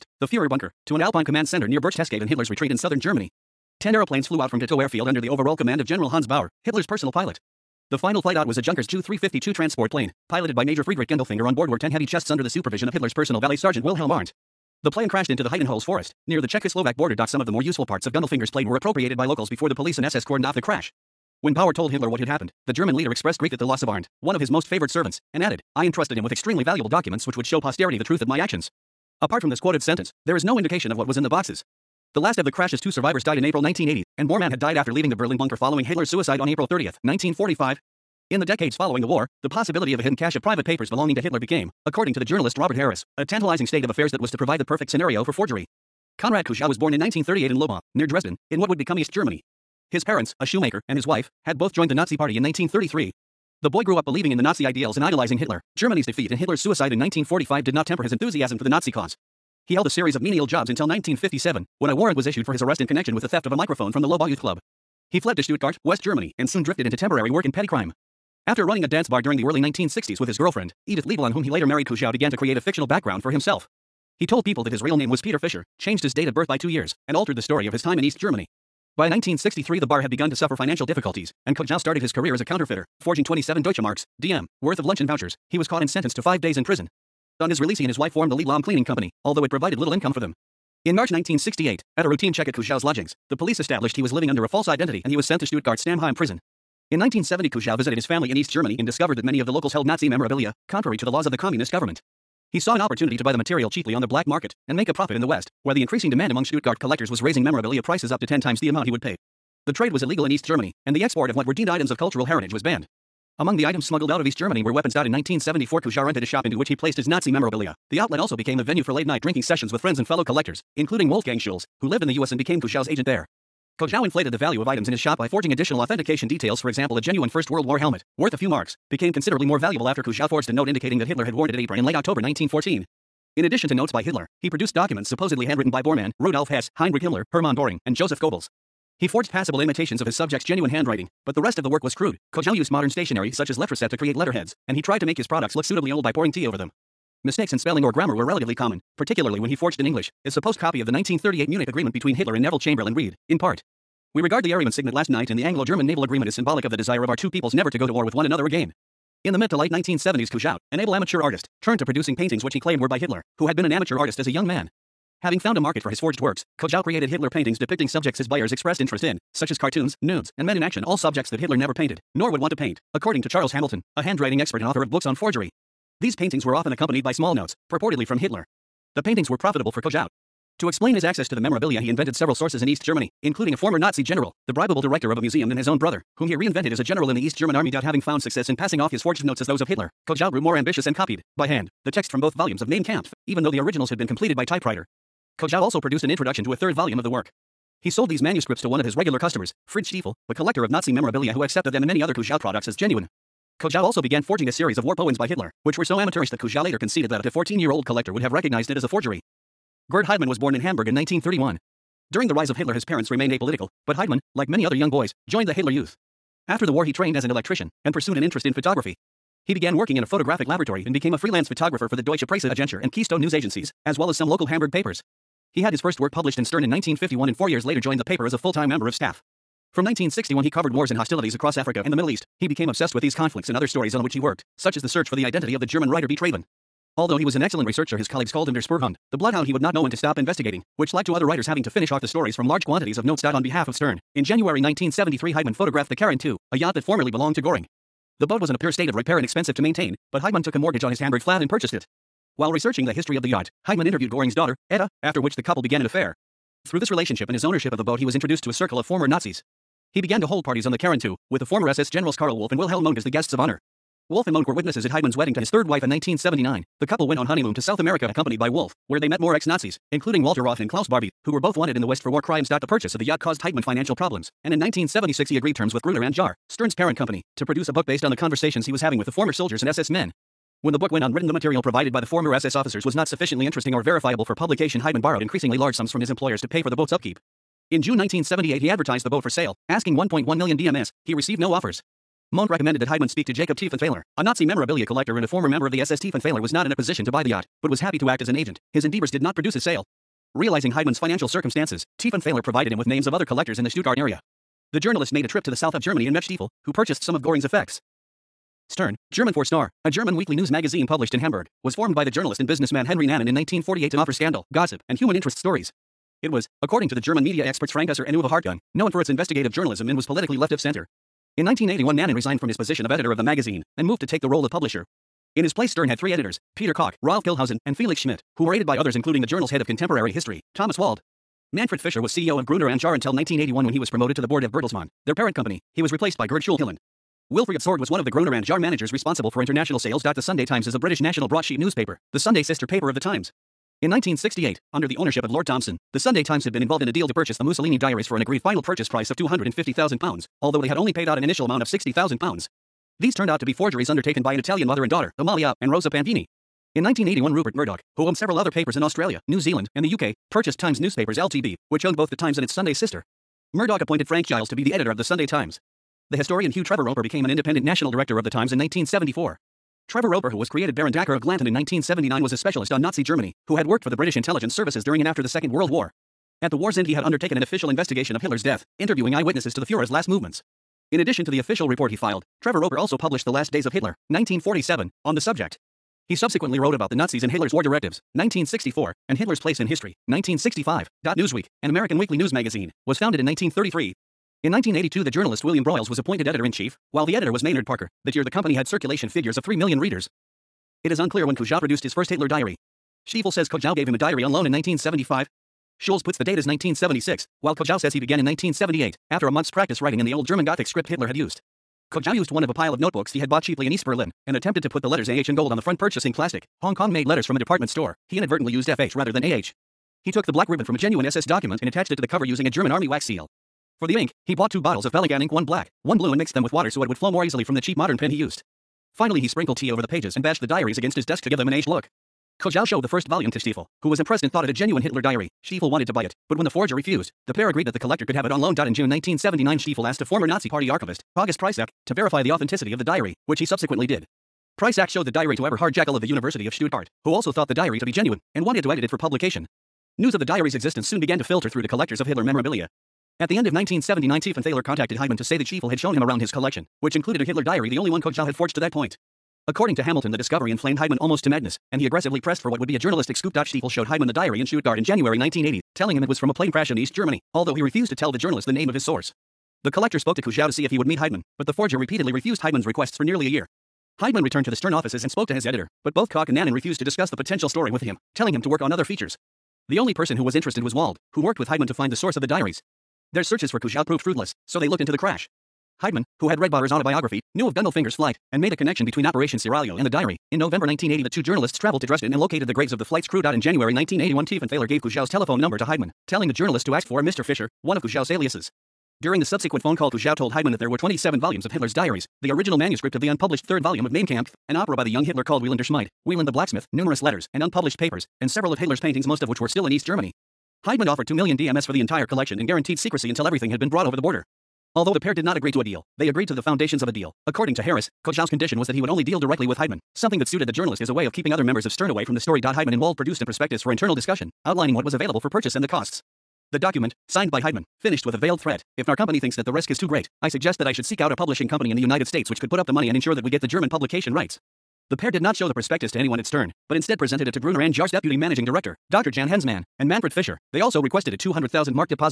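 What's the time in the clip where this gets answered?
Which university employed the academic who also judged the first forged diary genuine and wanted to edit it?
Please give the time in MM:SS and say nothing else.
07:26.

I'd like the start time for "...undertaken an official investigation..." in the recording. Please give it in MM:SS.
06:17.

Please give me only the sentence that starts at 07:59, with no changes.
The only person who was interested was Wald, who worked with Heidemann to find the source of the diaries.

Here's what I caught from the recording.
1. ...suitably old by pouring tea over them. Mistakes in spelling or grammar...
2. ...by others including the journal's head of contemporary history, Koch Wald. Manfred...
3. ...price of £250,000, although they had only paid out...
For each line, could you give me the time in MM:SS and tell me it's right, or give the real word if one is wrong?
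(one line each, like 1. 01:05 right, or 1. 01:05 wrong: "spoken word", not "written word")
1. 02:25 right
2. 05:28 wrong: "Thomas", not "Koch"
3. 05:48 right.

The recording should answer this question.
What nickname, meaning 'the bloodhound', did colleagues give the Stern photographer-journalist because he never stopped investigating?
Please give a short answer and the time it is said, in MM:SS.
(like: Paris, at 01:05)
der Spurhund, at 03:58.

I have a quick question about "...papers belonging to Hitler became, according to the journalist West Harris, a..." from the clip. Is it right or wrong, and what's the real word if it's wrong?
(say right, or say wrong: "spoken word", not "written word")
wrong: "Robert", not "West".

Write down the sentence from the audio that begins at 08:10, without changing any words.
In November 1980, the two journalists traveled to Dresden and located the graves of the flight's crew.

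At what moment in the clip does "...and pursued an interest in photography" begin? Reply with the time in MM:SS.
03:37.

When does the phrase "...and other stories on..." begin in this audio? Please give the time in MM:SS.
03:53.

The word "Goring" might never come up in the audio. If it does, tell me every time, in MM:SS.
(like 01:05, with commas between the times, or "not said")
04:07, 04:14, 05:07.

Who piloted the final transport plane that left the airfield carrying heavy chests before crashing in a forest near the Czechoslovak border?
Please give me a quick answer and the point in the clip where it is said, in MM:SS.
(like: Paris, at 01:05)
Friedrich Gundelfinger, at 00:10.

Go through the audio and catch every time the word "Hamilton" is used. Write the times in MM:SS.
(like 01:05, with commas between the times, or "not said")
02:53, 07:39.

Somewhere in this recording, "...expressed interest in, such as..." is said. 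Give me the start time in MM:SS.
02:48.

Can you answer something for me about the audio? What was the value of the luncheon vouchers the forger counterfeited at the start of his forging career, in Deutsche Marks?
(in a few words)
27.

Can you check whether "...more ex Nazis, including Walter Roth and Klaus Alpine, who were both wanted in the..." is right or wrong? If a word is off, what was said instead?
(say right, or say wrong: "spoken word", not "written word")
wrong: "Barbie", not "Alpine".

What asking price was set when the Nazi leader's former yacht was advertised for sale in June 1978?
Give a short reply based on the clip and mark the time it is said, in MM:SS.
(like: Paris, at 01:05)
1.1 million DM, at 04:49.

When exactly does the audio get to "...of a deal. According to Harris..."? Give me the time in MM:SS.
08:36.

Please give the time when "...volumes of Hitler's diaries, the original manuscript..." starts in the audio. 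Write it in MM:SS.
08:21.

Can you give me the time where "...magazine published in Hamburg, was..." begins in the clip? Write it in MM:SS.
05:10.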